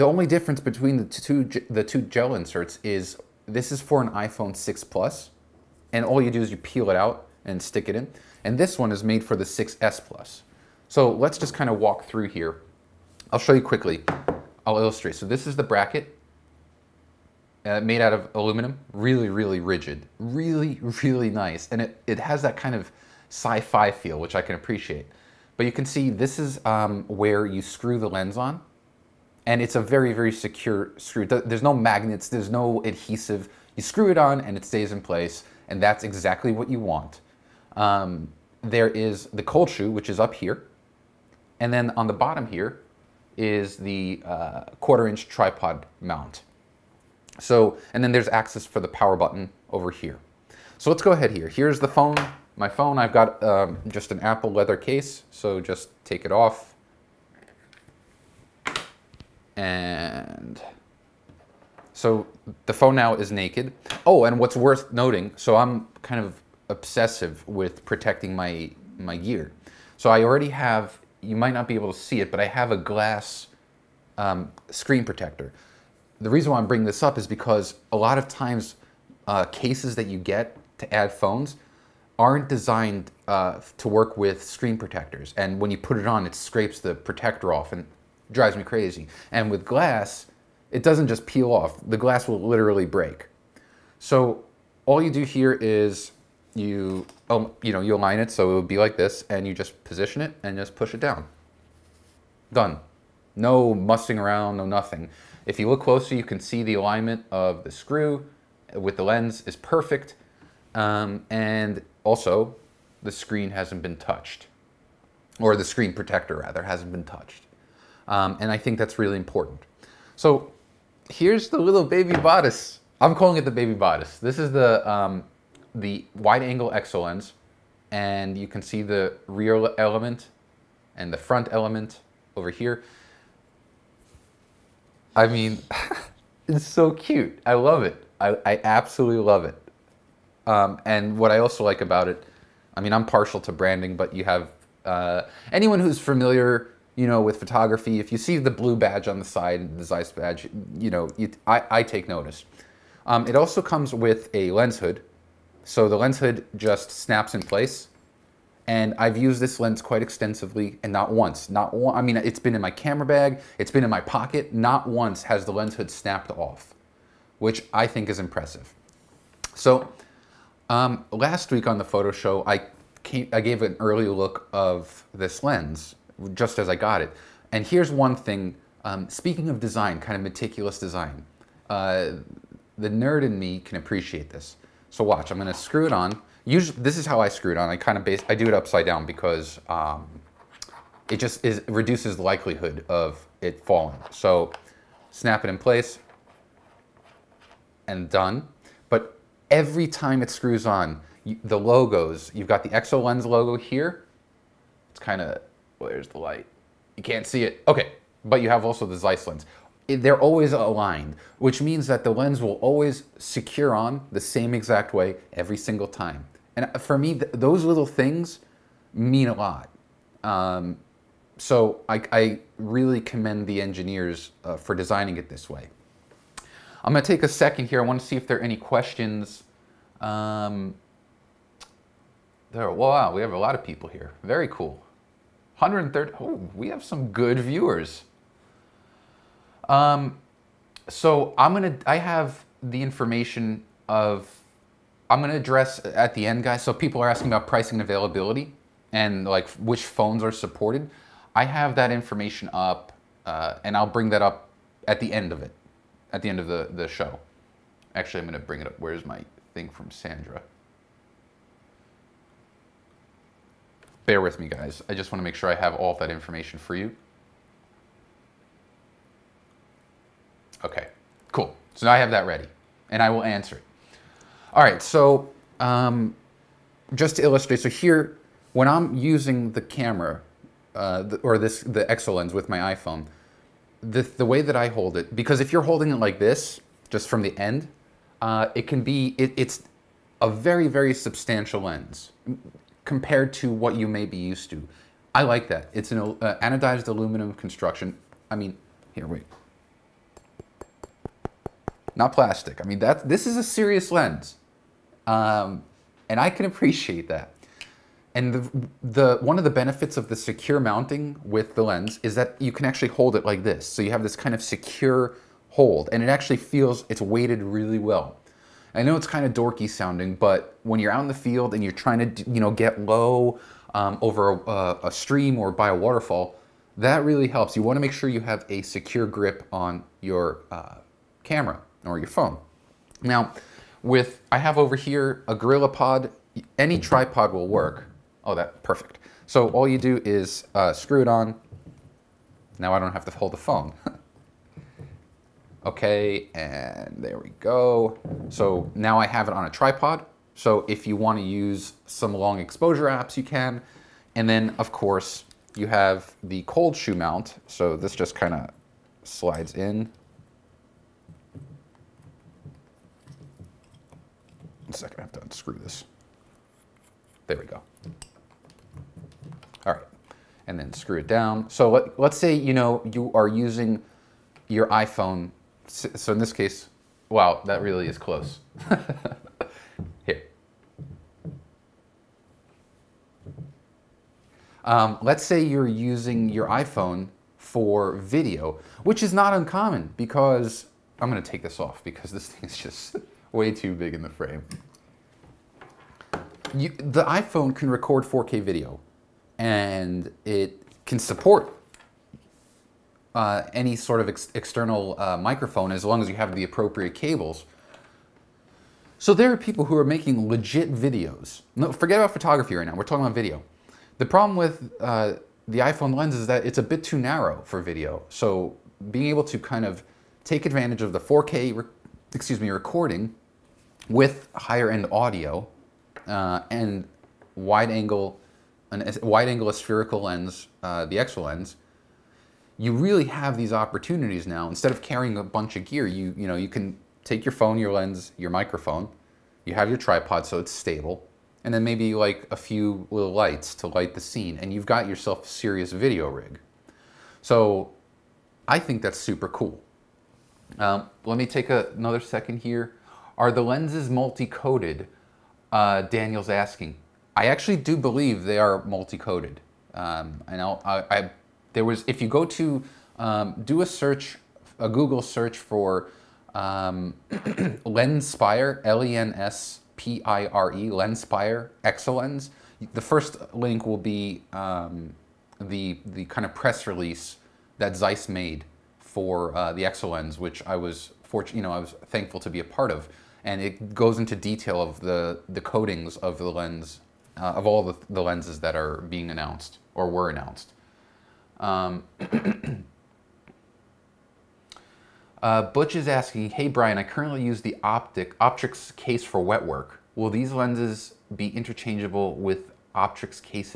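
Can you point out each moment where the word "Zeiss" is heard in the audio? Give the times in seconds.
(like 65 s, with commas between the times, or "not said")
149 s, 208 s, 477 s.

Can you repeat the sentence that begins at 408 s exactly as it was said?
So there are people who are making legit videos.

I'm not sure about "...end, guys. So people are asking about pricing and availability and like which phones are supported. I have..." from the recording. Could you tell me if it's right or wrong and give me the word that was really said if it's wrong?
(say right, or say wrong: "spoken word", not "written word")
right.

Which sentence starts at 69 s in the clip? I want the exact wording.
So I already have, you might not be able to see it, but I have a glass um, screen protector.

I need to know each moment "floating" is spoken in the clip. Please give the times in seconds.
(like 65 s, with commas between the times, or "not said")
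not said.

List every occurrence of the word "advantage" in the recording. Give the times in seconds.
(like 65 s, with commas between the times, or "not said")
420 s.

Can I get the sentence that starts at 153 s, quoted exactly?
Um, it also comes with a lens hood.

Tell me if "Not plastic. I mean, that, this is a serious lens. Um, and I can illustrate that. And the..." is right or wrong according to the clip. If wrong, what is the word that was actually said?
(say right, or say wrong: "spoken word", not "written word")
wrong: "appreciate", not "illustrate".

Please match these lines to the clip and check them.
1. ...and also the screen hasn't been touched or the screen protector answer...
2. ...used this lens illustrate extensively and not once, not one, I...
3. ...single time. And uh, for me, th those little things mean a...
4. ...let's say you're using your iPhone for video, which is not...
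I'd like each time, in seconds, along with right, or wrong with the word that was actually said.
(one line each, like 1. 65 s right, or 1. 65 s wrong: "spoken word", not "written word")
1. 111 s wrong: "rather", not "answer"
2. 159 s wrong: "quite", not "illustrate"
3. 215 s right
4. 385 s right.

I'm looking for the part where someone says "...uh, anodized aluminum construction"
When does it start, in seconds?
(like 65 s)
295 s.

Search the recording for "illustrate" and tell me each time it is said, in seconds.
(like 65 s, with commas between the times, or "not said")
14 s, 277 s.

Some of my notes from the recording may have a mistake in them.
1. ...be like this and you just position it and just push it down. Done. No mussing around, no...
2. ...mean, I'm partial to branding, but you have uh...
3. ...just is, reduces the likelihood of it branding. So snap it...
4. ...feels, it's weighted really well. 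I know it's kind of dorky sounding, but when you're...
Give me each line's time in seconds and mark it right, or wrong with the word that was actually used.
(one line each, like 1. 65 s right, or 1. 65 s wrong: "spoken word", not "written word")
1. 98 s right
2. 142 s right
3. 191 s wrong: "falling", not "branding"
4. 316 s right.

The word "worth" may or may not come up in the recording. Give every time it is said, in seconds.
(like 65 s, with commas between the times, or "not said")
64 s.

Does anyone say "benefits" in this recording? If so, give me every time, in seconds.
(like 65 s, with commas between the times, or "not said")
309 s.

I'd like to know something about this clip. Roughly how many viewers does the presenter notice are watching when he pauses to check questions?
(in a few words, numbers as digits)
130.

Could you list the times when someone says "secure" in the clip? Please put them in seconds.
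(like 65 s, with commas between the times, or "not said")
30 s, 213 s, 310 s, 314 s, 328 s.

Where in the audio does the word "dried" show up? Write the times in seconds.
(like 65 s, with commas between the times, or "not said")
not said.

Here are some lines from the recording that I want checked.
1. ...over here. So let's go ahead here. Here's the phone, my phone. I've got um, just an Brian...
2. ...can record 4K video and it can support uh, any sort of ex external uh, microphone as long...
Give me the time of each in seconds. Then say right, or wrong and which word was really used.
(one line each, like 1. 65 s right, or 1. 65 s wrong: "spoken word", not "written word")
1. 49 s wrong: "Apple", not "Brian"
2. 397 s right.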